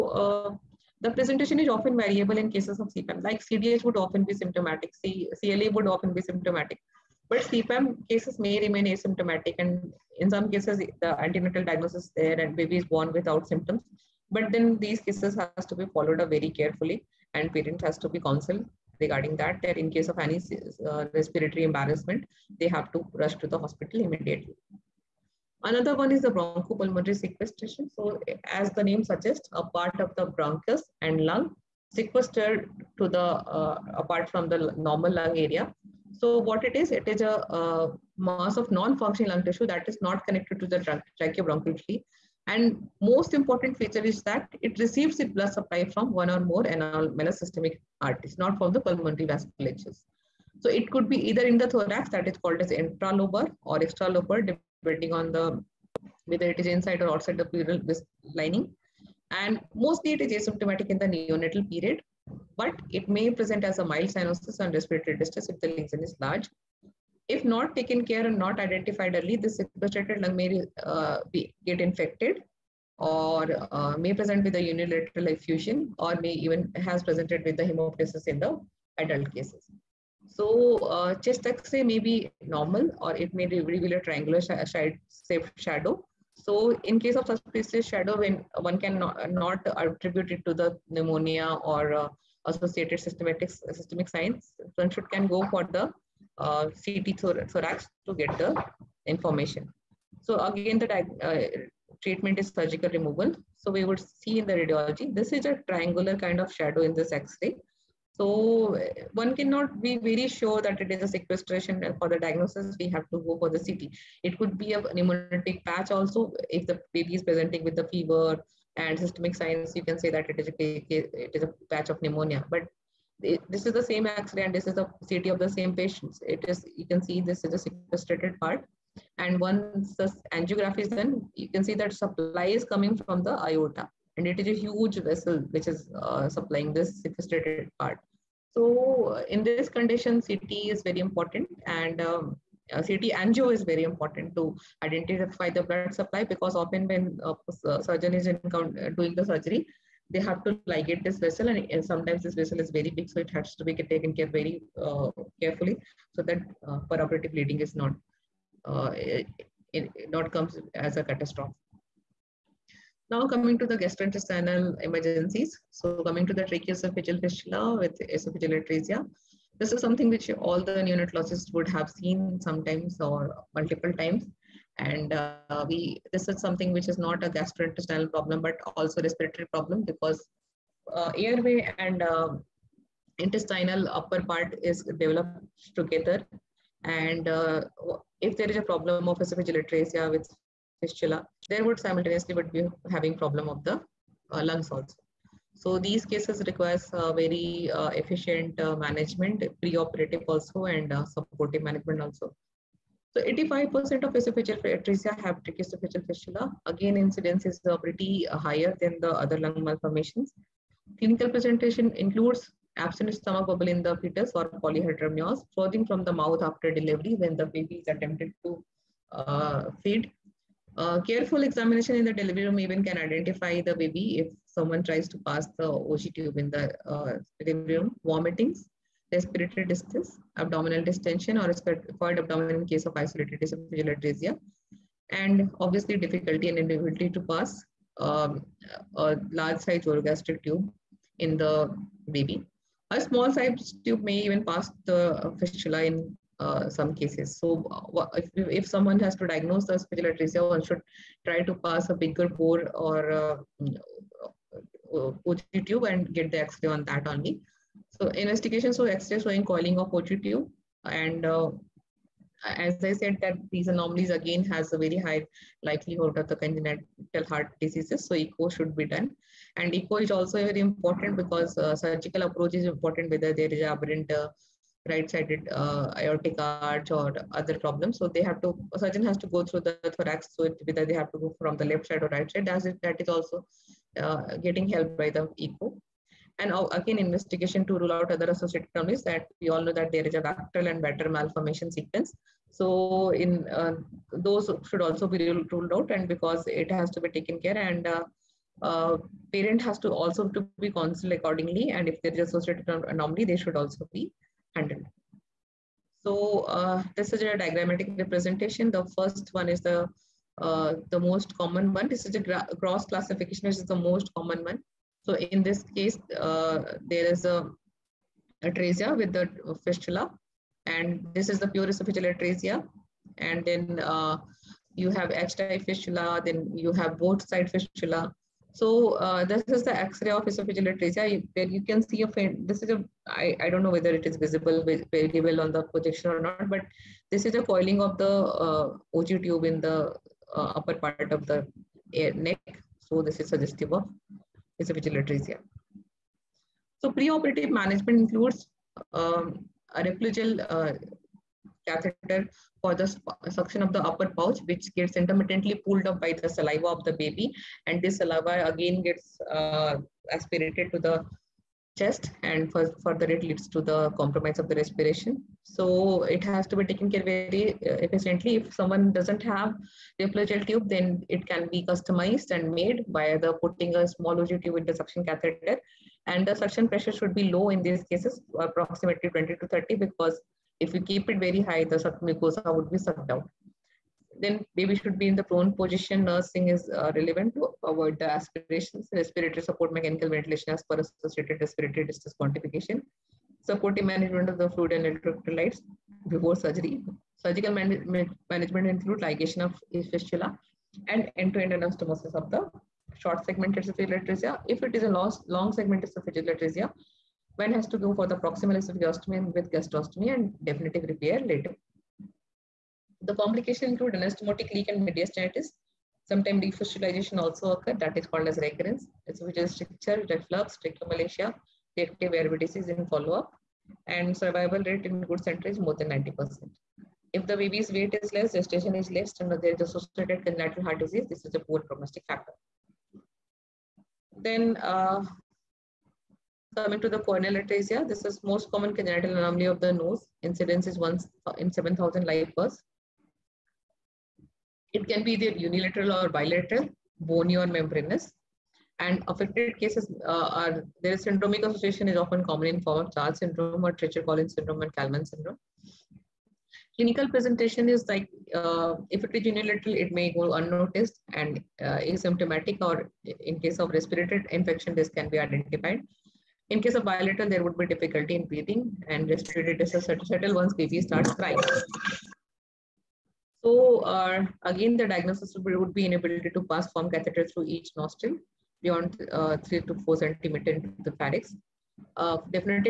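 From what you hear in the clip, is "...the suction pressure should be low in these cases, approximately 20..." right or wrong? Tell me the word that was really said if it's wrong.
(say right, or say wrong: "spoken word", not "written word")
right.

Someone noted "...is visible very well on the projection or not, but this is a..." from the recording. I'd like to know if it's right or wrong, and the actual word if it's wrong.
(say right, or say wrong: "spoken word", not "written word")
right.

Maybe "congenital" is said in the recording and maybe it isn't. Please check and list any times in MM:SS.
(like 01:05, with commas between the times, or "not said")
04:26, 07:10, 07:18.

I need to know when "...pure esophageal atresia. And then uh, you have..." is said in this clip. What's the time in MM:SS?
05:21.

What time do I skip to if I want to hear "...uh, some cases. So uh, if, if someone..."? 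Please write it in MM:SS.
04:06.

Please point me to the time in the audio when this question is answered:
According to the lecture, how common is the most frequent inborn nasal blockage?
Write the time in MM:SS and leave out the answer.
07:20.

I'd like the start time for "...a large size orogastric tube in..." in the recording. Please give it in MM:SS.
03:58.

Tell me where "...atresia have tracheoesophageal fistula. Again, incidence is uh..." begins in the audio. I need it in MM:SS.
03:24.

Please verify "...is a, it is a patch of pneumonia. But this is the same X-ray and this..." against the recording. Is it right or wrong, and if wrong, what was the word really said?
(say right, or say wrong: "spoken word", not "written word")
right.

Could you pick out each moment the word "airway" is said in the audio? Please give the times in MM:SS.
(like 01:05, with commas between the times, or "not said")
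03:01, 07:02.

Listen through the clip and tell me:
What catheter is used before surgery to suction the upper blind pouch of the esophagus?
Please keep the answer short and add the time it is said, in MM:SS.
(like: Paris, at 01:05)
Replogle catheter, at 05:49.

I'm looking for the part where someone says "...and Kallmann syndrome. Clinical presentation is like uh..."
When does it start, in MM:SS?
07:34.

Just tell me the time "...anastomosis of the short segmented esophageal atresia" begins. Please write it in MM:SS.
06:41.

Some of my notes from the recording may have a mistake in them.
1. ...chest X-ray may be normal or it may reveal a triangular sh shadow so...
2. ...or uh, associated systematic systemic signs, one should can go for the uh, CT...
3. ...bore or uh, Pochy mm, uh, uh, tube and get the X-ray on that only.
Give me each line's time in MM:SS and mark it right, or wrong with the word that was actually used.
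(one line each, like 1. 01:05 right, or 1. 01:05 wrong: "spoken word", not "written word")
1. 01:21 right
2. 01:31 right
3. 04:12 right.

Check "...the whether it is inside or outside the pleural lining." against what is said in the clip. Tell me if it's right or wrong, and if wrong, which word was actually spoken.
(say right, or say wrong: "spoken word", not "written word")
right.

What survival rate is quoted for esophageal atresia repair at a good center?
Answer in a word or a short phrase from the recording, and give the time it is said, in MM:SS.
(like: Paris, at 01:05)
More than 90%, at 07:05.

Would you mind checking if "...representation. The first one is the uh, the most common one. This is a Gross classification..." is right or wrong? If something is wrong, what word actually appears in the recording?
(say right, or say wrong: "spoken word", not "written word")
right.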